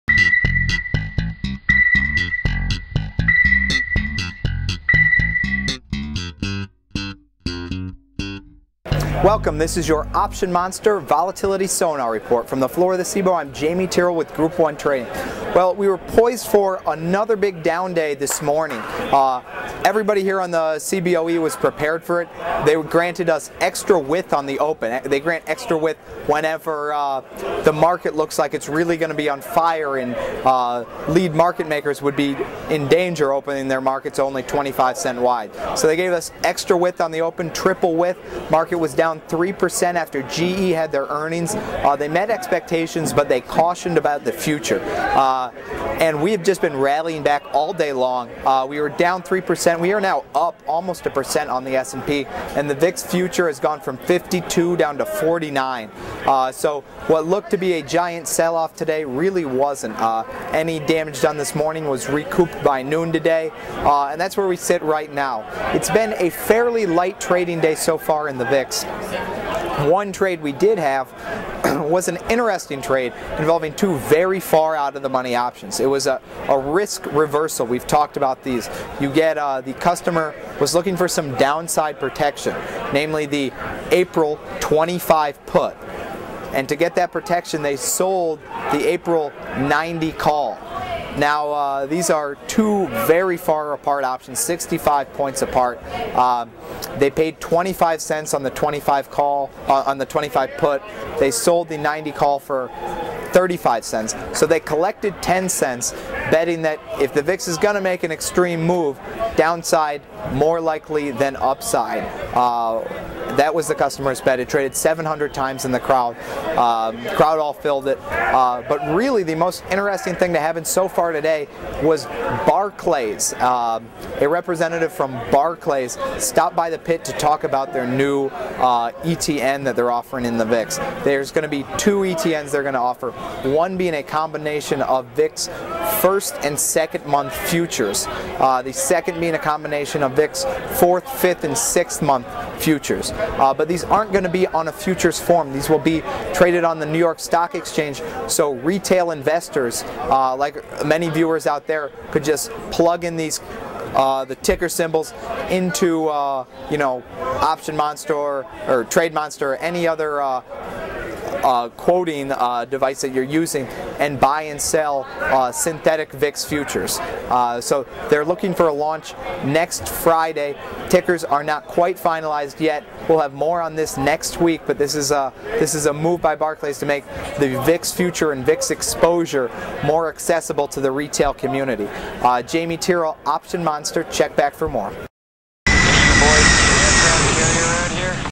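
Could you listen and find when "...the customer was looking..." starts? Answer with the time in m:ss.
1:19.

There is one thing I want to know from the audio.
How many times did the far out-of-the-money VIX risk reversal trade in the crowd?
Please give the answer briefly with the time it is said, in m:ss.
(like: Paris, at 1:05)
700, at 1:54.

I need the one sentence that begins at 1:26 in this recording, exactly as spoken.
And to get that protection, they sold the April 90 call.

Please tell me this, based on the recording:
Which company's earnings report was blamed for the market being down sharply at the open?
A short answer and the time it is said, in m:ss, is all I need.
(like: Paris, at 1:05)
GE, at 0:40.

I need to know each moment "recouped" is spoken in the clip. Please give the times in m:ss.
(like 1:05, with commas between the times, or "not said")
1:02.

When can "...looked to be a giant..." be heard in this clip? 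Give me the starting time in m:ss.
0:57.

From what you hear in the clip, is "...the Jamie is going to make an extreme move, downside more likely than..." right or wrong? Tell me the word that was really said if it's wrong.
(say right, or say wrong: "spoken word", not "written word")
wrong: "VIX", not "Jamie".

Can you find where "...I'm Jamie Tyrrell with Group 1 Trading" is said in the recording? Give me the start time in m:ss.
0:13.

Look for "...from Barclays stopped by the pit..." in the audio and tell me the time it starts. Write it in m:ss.
2:04.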